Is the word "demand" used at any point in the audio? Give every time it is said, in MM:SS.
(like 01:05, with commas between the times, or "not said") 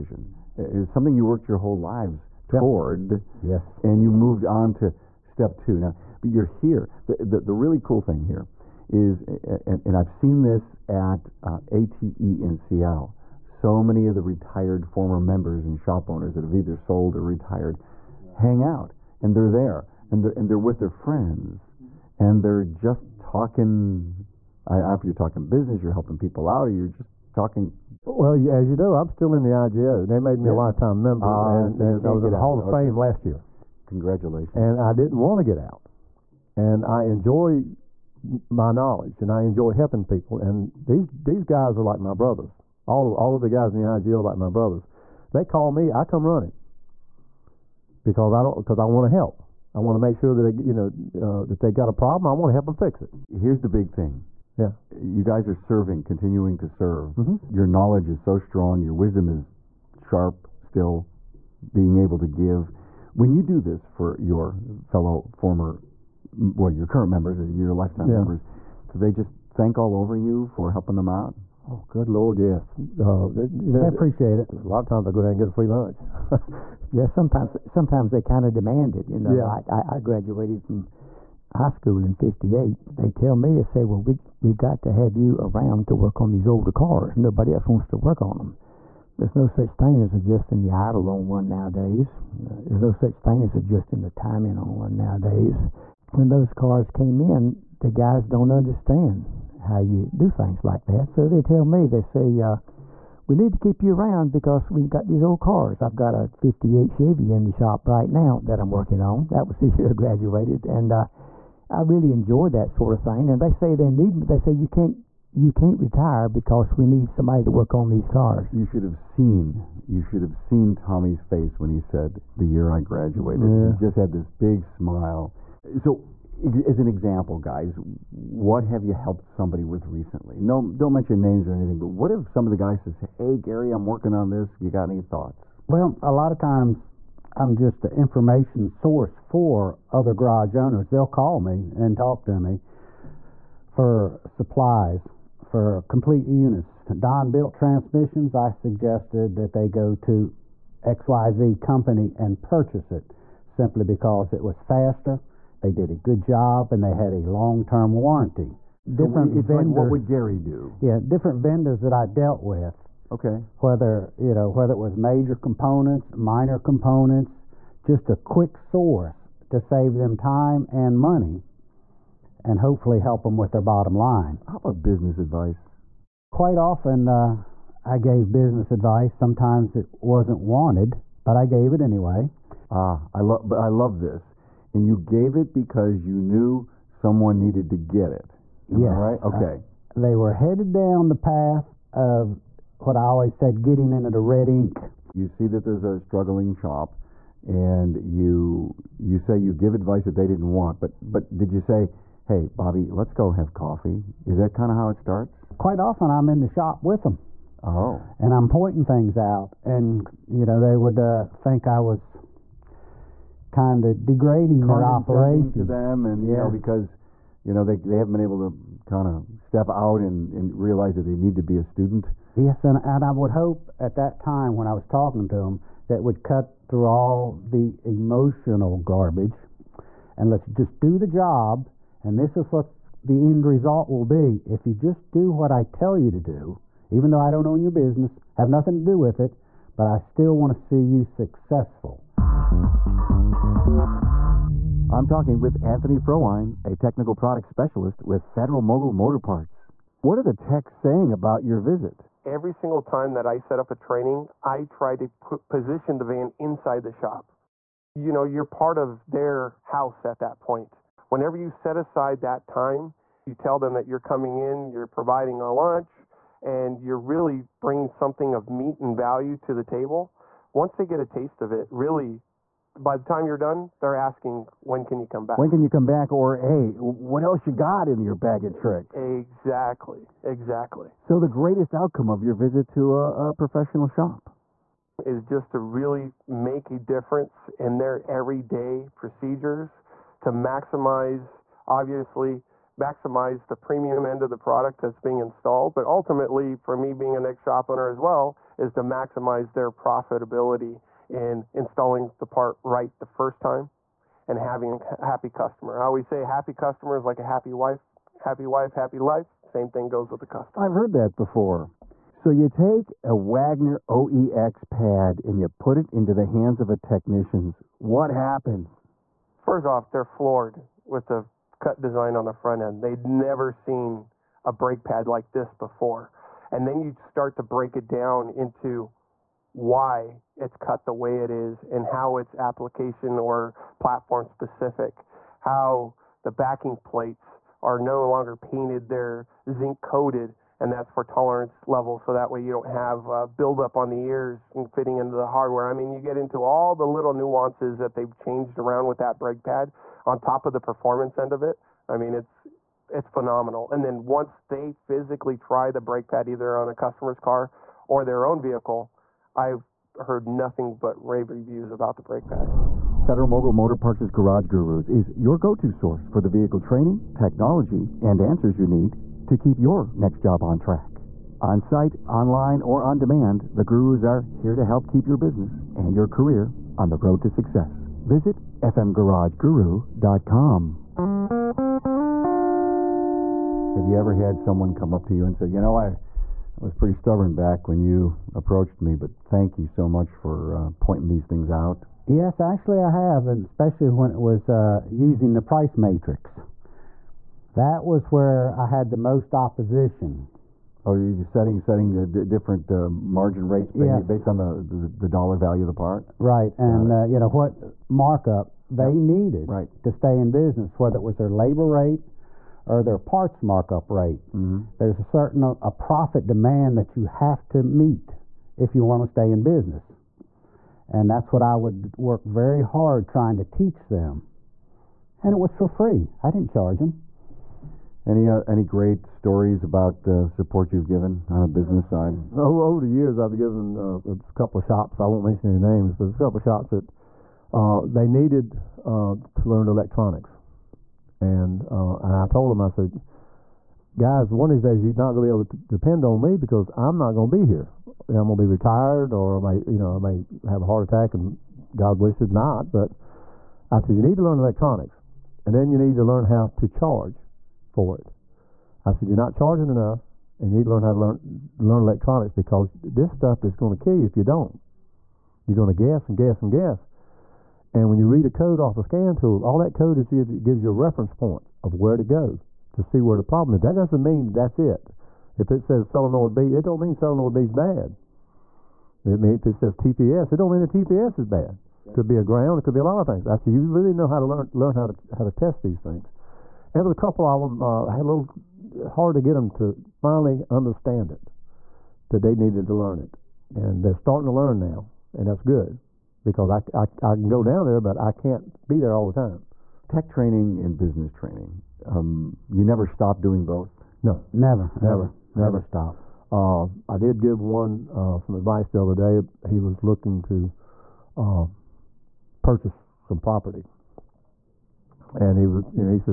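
01:18, 06:12, 06:56.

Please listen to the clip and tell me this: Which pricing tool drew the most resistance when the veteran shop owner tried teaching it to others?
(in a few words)
price matrix.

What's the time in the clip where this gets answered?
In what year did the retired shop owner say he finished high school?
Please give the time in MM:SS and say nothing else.
01:22.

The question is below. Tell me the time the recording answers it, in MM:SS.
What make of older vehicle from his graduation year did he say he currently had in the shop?
01:46.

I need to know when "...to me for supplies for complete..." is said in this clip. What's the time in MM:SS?
02:22.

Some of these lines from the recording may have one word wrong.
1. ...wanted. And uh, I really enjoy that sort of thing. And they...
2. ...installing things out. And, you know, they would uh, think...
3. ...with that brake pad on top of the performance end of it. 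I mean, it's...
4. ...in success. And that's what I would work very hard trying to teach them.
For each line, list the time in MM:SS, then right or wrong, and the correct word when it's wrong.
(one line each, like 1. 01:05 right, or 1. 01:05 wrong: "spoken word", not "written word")
1. 01:49 wrong: "graduated", not "wanted"
2. 03:28 wrong: "pointing", not "installing"
3. 05:48 right
4. 06:59 wrong: "business", not "success".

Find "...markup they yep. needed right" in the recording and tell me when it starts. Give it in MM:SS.
06:47.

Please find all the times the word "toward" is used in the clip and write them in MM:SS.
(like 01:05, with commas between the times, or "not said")
00:02.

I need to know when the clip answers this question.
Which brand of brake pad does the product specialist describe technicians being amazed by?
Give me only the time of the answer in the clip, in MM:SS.
05:13.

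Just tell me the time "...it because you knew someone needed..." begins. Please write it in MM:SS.
03:05.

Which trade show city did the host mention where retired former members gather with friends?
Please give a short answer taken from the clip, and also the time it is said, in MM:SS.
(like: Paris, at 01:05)
Seattle, at 00:12.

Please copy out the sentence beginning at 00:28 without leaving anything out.
Well, as you know, I'm still in the IGO.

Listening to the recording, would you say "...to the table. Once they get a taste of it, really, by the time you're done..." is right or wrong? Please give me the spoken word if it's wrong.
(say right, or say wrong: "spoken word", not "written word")
right.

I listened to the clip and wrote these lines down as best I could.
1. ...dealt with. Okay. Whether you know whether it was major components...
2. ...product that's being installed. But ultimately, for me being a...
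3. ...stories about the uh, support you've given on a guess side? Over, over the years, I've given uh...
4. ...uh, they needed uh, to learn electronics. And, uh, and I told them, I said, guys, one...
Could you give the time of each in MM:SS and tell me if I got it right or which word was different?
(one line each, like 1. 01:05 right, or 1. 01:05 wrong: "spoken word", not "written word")
1. 02:42 right
2. 04:54 right
3. 07:09 wrong: "business", not "guess"
4. 07:17 right.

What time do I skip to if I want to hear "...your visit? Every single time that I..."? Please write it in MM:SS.
04:11.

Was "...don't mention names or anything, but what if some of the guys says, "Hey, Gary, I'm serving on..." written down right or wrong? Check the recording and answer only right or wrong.
wrong.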